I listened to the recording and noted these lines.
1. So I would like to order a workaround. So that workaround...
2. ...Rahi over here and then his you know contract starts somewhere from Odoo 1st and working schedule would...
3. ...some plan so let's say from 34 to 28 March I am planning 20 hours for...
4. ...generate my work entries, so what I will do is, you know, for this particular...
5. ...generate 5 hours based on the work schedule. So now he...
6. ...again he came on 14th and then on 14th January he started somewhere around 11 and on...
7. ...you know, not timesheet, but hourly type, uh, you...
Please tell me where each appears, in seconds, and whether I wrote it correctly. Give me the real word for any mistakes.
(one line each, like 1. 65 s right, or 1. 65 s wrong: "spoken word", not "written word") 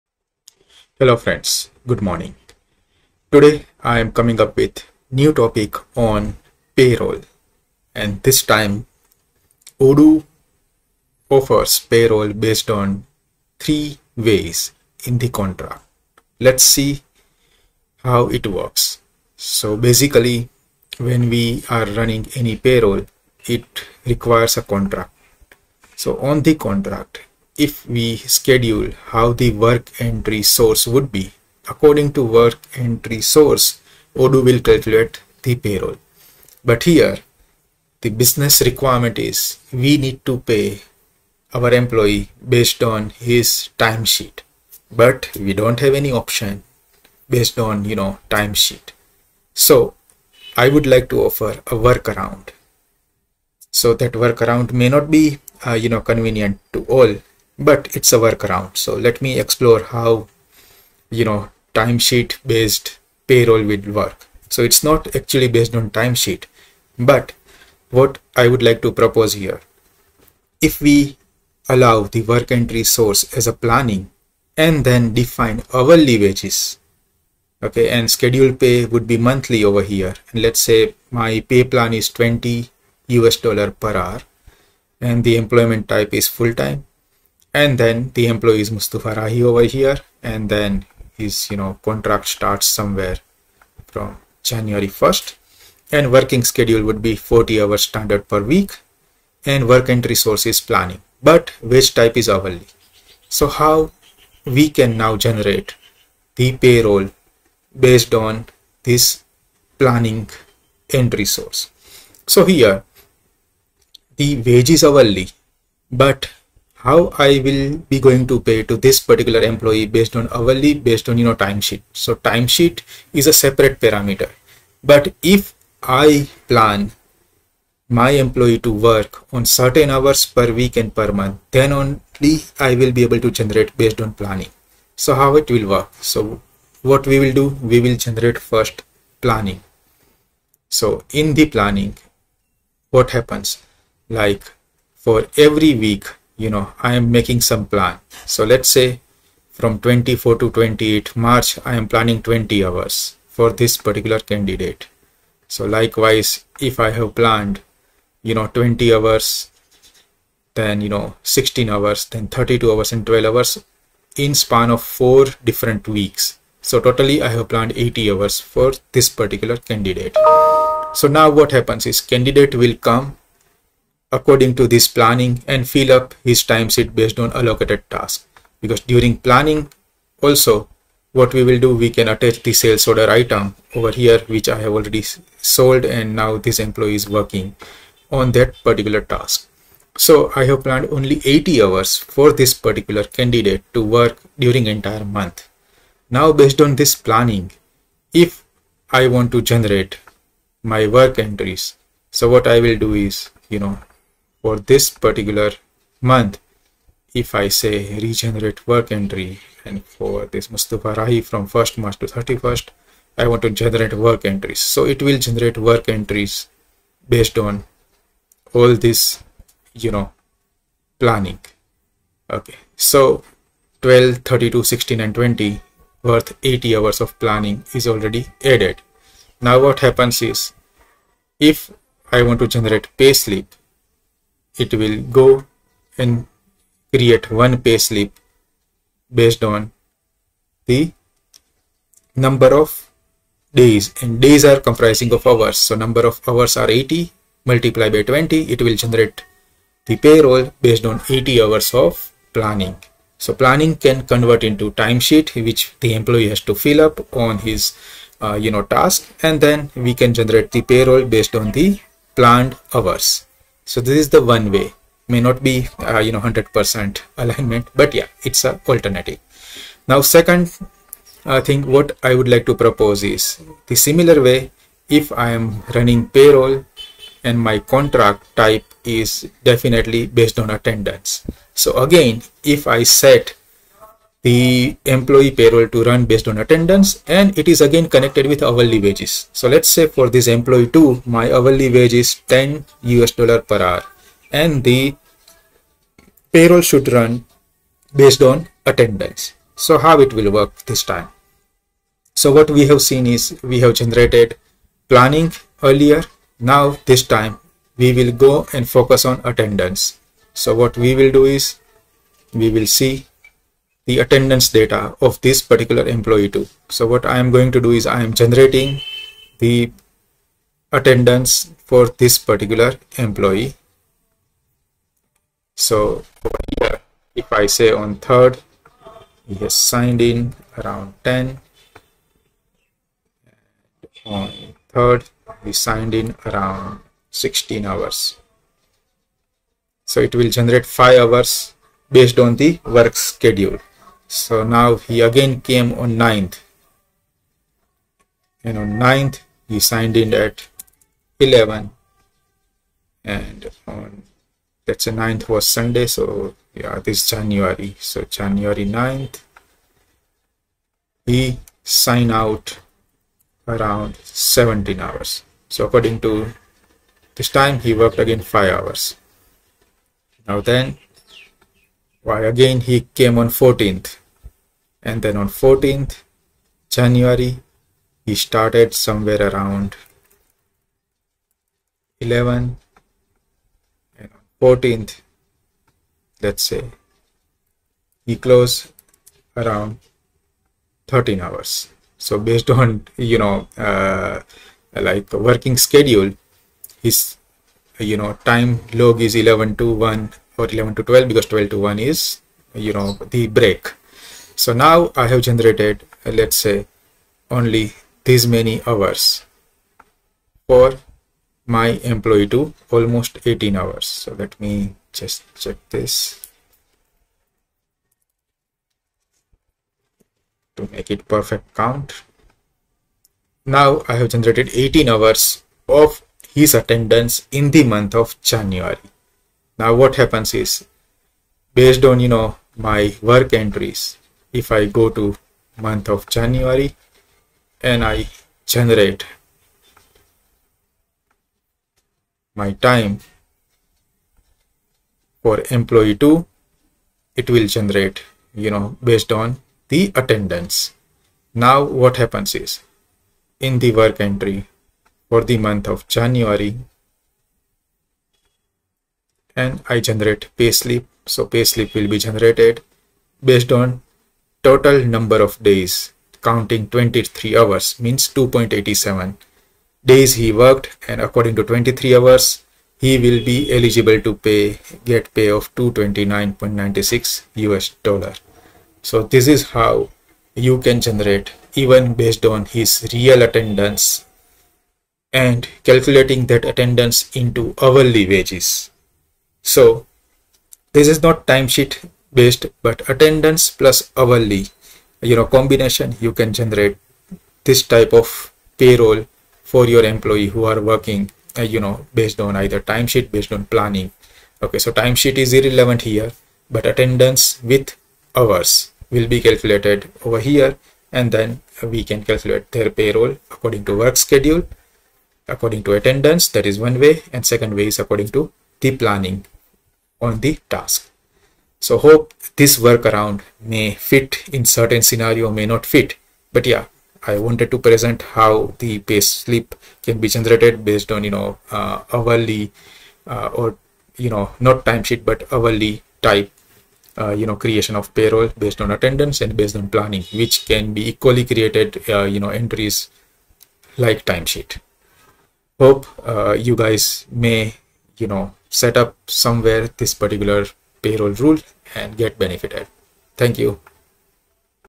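1. 49 s wrong: "offer", not "order"
2. 89 s wrong: "January", not "Odoo"
3. 147 s wrong: "24", not "34"
4. 199 s right
5. 340 s right
6. 372 s right
7. 533 s right.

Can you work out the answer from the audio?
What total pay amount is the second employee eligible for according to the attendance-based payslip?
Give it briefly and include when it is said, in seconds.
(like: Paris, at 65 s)
229.96 US dollars, at 475 s.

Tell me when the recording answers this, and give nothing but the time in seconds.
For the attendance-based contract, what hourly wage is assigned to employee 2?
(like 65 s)
292 s.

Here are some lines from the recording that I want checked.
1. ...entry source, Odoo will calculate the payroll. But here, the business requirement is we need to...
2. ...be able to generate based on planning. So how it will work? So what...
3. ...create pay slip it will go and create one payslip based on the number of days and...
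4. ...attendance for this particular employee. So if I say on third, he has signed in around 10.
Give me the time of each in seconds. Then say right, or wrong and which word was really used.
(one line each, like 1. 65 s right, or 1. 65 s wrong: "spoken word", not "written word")
1. 32 s right
2. 132 s right
3. 232 s wrong: "generate", not "create"
4. 320 s right.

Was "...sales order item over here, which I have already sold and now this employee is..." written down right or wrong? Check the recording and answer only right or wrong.
right.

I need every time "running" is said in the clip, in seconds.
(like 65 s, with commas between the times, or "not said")
21 s, 275 s.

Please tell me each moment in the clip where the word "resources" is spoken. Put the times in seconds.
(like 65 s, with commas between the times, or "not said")
100 s.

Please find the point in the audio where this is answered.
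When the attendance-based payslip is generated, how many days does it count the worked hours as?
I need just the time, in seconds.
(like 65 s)
468 s.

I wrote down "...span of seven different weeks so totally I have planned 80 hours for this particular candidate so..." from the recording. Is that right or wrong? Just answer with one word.
wrong.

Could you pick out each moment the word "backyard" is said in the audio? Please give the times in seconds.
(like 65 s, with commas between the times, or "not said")
not said.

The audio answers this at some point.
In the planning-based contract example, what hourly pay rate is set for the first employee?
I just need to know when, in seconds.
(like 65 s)
82 s.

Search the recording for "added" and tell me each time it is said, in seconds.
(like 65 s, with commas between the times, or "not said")
228 s.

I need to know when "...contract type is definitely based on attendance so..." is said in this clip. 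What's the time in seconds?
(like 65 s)
277 s.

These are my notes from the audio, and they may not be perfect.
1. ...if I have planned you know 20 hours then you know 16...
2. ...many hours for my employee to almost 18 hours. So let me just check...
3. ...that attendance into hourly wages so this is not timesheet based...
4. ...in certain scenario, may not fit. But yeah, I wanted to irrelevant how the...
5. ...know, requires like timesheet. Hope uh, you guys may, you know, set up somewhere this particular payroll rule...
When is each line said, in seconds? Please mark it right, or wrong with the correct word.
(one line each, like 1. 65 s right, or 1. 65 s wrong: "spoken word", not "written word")
1. 156 s right
2. 408 s right
3. 486 s right
4. 524 s wrong: "present", not "irrelevant"
5. 542 s wrong: "entries", not "requires".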